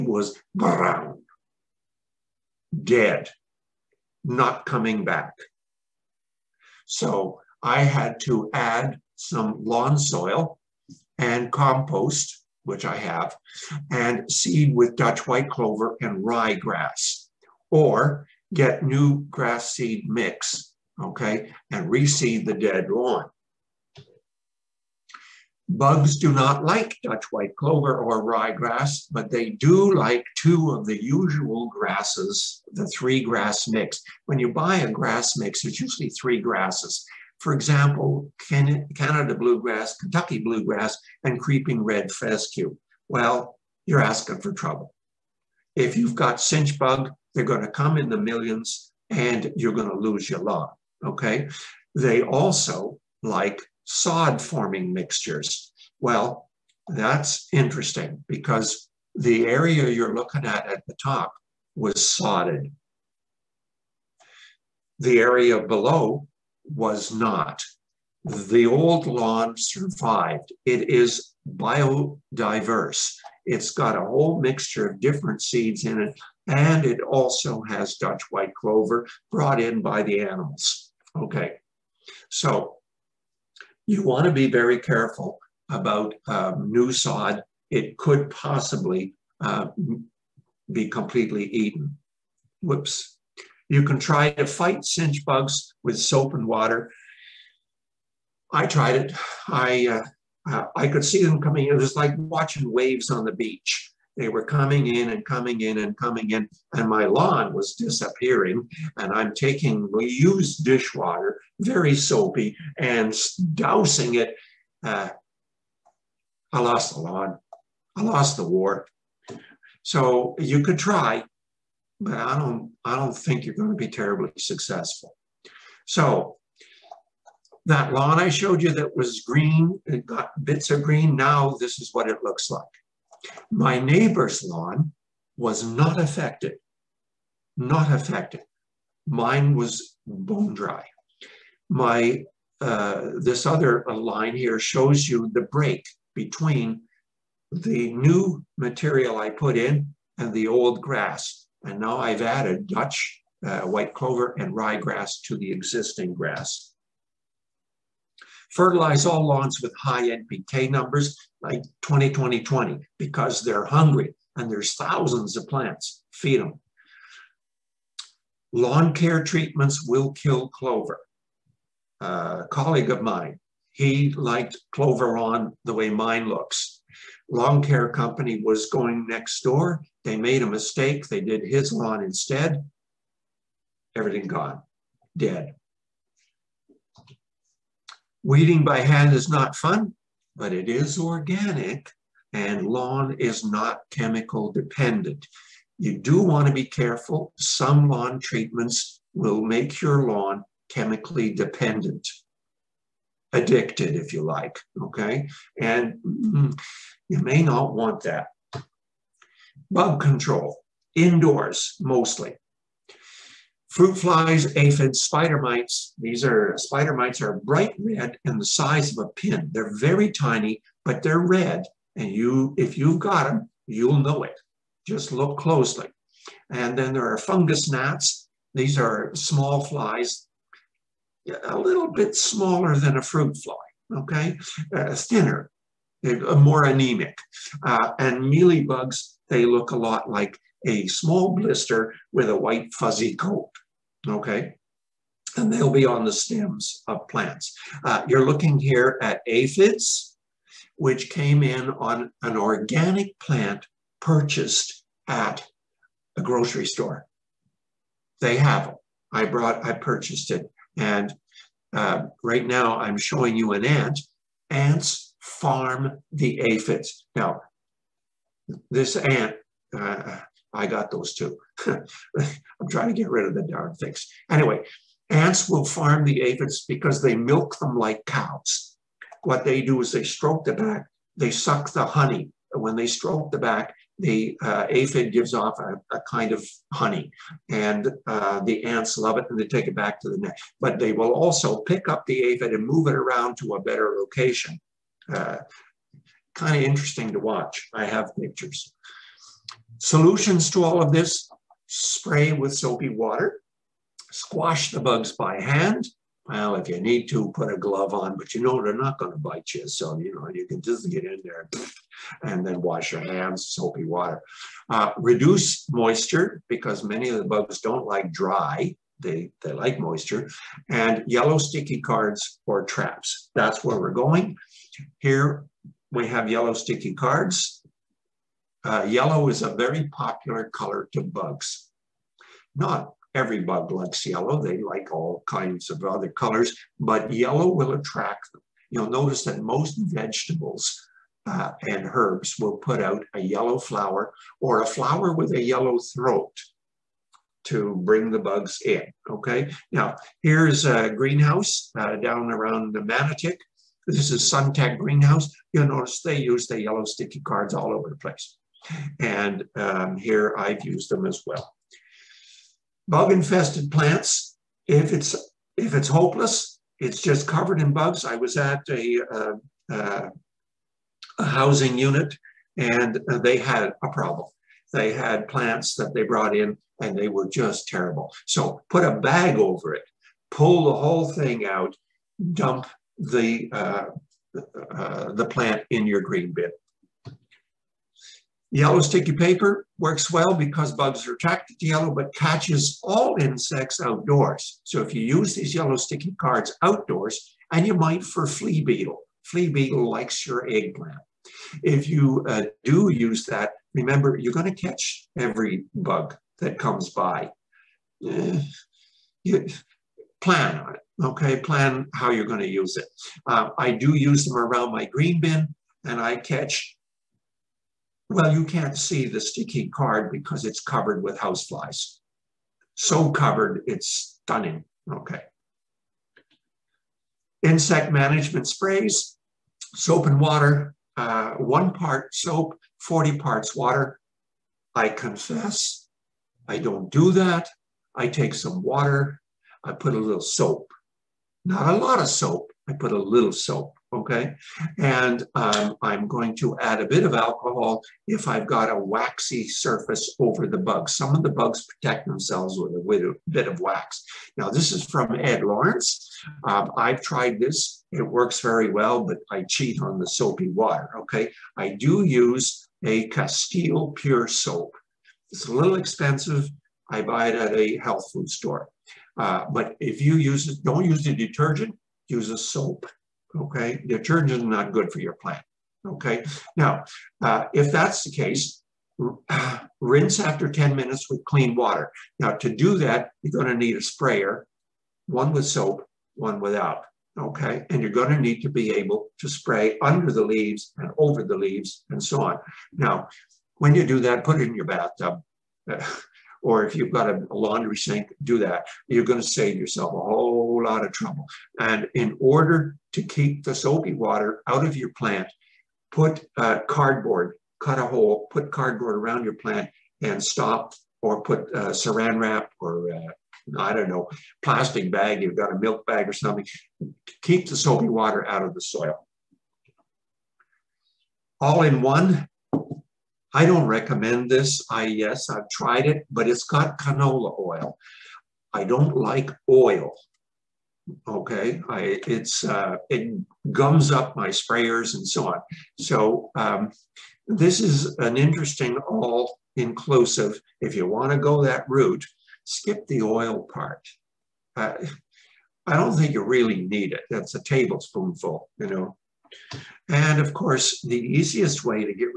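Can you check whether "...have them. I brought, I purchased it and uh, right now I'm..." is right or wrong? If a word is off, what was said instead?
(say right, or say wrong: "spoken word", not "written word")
right.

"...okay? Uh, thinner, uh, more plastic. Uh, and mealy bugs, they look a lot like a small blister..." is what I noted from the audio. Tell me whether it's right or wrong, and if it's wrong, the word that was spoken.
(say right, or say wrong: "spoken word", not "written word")
wrong: "anemic", not "plastic".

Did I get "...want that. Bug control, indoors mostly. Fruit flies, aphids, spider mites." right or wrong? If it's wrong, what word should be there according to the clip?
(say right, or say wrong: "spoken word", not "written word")
right.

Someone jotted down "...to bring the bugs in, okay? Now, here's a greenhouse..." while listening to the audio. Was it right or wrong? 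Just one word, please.
right.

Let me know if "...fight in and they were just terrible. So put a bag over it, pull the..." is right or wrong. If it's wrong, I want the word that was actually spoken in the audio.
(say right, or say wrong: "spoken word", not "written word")
wrong: "brought", not "fight".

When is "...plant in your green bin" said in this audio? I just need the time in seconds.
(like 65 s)
385 s.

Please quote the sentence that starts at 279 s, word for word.
What they do is they stroke the back, they suck the honey.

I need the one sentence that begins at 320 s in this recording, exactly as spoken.
And yellow sticky cards or traps.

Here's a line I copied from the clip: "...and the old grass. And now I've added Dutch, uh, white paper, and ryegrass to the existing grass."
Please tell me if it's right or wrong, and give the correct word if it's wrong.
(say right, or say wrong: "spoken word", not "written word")
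wrong: "clover", not "paper".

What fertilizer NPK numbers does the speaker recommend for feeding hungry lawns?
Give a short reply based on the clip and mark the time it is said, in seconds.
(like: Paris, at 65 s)
20-20-20, at 161 s.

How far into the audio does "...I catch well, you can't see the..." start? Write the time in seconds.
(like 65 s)
415 s.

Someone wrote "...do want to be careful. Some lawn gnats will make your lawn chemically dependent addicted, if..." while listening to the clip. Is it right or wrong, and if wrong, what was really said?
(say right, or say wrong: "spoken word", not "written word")
wrong: "treatments", not "gnats".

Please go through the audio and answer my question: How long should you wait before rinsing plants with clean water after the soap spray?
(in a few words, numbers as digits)
10 minutes.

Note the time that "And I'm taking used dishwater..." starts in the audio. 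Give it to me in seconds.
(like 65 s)
108 s.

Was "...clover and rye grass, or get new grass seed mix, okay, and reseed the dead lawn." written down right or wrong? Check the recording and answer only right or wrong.
right.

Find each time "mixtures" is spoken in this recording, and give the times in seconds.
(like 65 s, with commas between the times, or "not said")
54 s, 74 s.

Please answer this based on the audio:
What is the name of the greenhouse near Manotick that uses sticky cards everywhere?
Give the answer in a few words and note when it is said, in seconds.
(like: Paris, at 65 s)
Suntech Greenhouse, at 354 s.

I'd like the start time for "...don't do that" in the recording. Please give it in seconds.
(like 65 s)
436 s.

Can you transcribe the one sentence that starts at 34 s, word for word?
When you buy a grass mix, it's usually three grasses.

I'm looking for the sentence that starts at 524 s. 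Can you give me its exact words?
I, yes, I've tried it, but it's got canola oil.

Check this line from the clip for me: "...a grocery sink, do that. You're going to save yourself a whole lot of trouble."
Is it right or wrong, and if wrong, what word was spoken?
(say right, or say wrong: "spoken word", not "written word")
wrong: "laundry", not "grocery".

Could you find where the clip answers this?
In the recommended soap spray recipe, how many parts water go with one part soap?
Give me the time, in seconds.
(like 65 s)
432 s.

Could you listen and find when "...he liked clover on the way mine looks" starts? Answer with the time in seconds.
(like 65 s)
173 s.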